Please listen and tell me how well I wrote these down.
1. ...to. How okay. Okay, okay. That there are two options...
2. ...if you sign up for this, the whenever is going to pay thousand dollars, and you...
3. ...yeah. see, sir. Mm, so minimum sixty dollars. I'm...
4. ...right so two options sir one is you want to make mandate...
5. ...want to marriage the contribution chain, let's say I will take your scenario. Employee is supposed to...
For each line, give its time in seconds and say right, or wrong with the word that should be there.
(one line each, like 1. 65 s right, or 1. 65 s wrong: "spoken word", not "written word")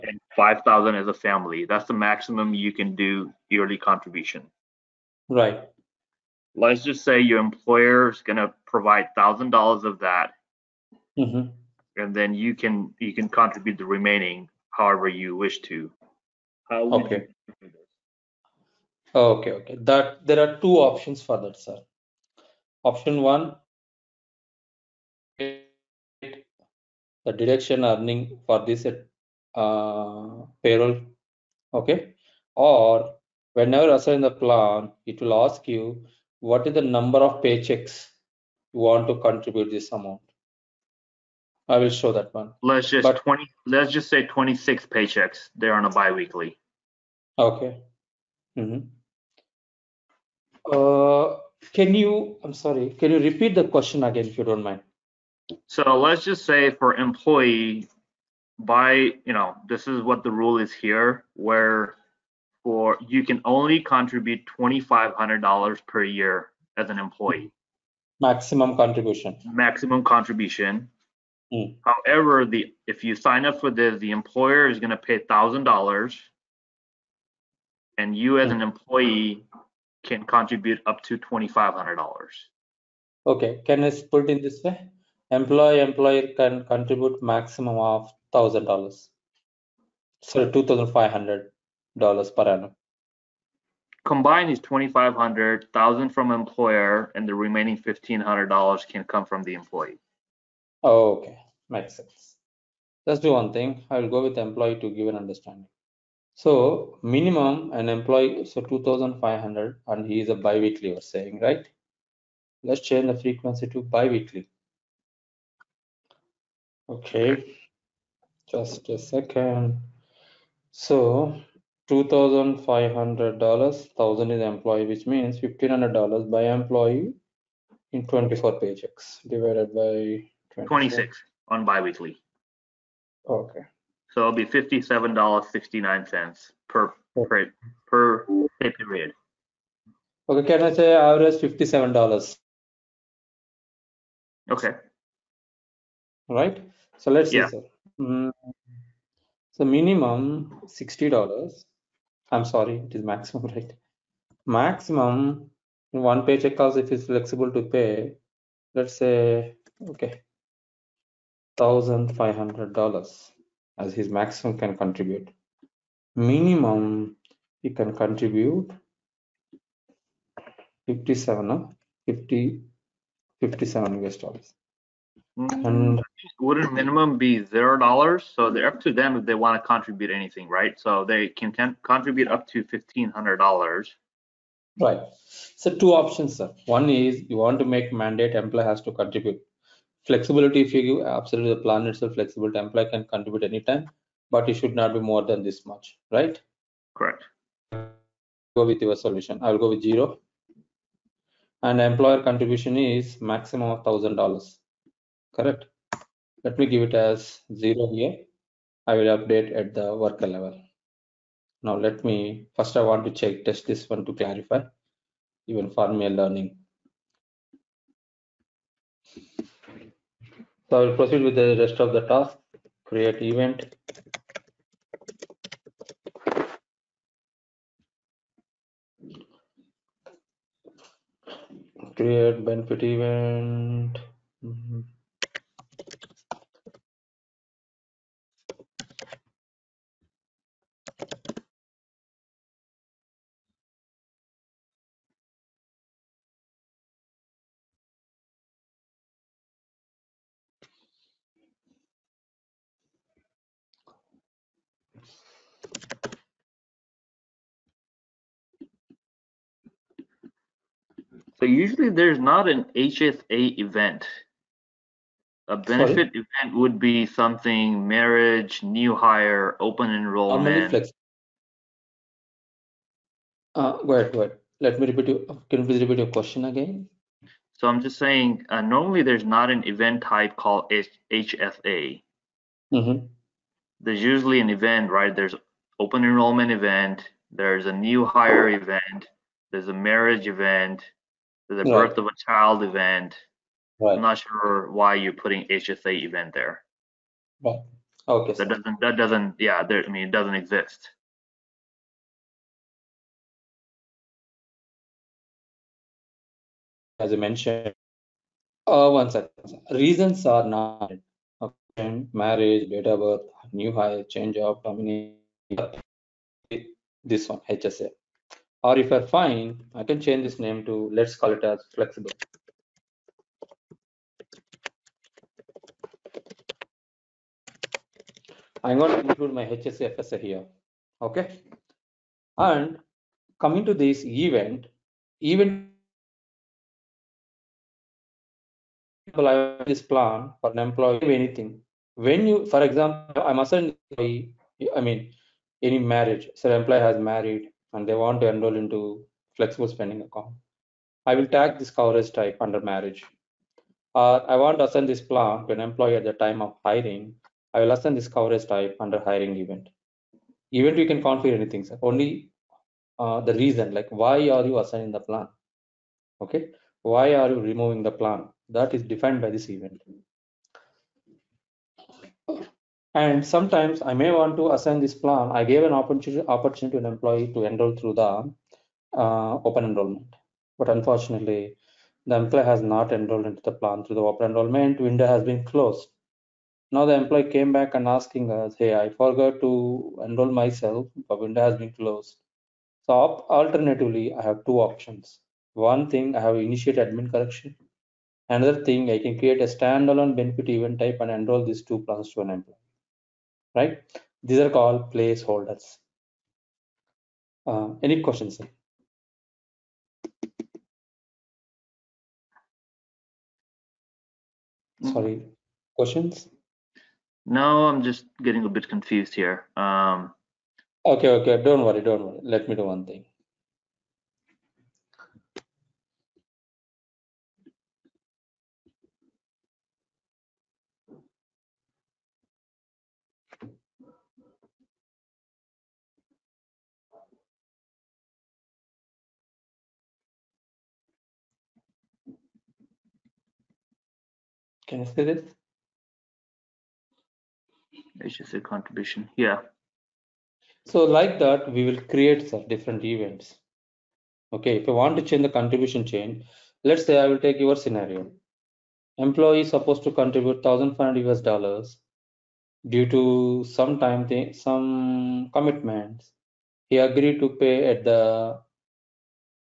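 1. 15 s right
2. 72 s wrong: "employer", not "whenever"
3. 147 s right
4. 184 s right
5. 454 s wrong: "change", not "marriage".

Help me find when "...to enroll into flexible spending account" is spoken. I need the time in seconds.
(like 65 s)
348 s.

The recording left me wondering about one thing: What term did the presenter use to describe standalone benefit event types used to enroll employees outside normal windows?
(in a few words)
placeholders.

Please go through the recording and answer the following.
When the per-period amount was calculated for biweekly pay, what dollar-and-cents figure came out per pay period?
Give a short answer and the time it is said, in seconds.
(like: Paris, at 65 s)
$57.69, at 134 s.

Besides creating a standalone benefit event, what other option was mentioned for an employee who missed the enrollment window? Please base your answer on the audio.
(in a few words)
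admin correction.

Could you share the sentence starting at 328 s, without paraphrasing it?
I'm going to include my HSFSA here.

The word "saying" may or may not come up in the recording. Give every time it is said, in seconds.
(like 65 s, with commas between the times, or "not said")
111 s, 277 s.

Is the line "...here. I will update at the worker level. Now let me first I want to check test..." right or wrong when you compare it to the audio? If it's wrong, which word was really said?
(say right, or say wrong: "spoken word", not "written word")
right.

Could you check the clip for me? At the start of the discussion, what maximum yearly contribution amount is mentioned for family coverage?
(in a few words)
5,000.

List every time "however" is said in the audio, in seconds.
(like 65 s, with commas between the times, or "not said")
14 s, 71 s.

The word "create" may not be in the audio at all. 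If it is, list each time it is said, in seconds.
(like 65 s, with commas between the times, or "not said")
222 s, 231 s, 399 s, 451 s.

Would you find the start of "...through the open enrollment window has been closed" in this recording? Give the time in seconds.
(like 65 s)
383 s.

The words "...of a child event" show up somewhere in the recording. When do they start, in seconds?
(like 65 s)
291 s.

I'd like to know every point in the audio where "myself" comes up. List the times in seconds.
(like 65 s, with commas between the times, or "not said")
390 s.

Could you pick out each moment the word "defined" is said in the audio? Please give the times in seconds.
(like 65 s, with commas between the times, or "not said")
368 s.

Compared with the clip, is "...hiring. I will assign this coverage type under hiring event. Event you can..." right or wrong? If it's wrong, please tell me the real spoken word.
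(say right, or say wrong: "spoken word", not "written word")
right.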